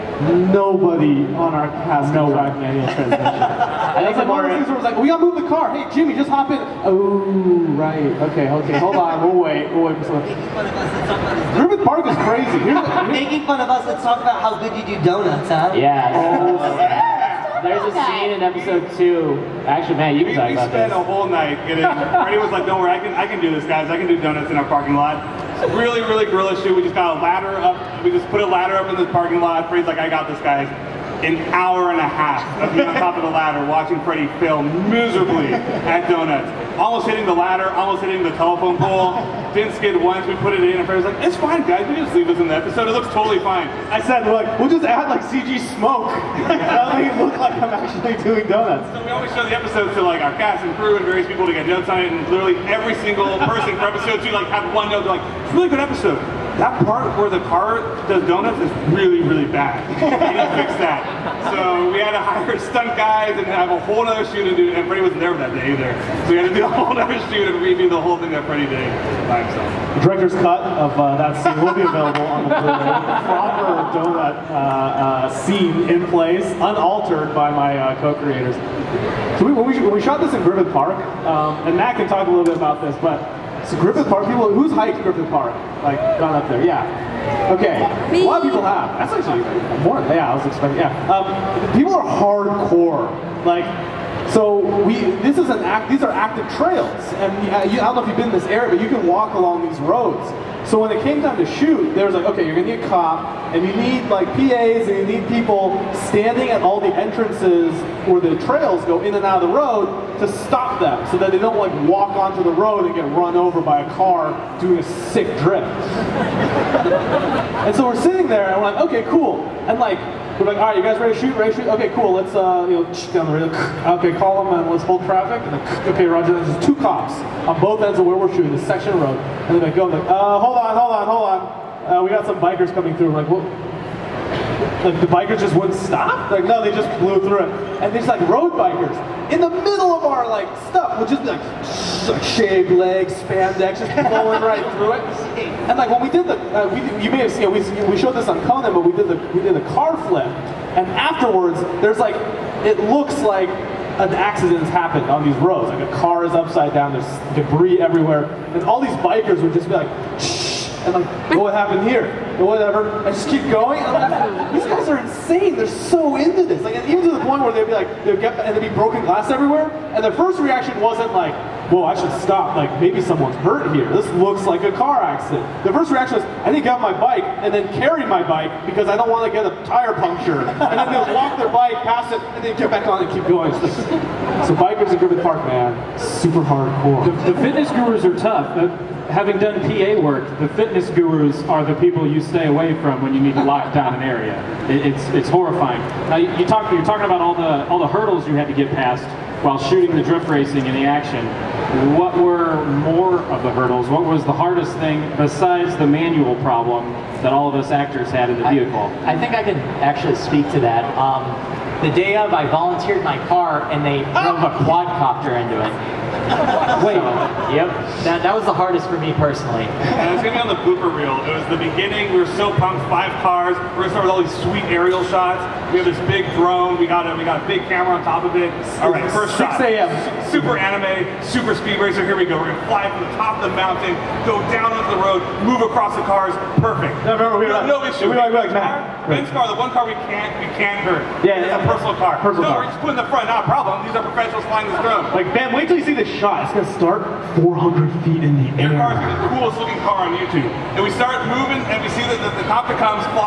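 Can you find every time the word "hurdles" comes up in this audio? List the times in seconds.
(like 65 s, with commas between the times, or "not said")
197 s, 203 s.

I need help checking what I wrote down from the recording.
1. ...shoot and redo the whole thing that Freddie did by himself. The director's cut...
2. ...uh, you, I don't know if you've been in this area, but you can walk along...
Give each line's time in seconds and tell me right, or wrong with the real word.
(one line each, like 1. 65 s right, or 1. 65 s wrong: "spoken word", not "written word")
1. 67 s right
2. 97 s right.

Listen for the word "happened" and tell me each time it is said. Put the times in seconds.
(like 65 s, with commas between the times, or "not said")
154 s, 161 s.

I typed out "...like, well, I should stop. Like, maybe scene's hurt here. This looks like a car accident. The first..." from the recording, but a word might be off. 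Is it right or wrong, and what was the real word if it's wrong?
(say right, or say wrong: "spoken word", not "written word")
wrong: "someone", not "scene".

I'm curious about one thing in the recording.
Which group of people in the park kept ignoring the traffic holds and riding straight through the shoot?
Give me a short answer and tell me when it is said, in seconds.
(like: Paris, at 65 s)
Road bikers, at 138 s.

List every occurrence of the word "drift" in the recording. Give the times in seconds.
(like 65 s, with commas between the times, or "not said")
115 s, 200 s.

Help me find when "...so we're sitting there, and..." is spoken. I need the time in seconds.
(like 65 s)
117 s.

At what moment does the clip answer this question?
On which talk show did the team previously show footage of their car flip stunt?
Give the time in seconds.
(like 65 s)
148 s.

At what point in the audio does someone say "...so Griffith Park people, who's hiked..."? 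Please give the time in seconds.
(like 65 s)
83 s.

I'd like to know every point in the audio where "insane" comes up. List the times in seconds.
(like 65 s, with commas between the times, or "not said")
164 s.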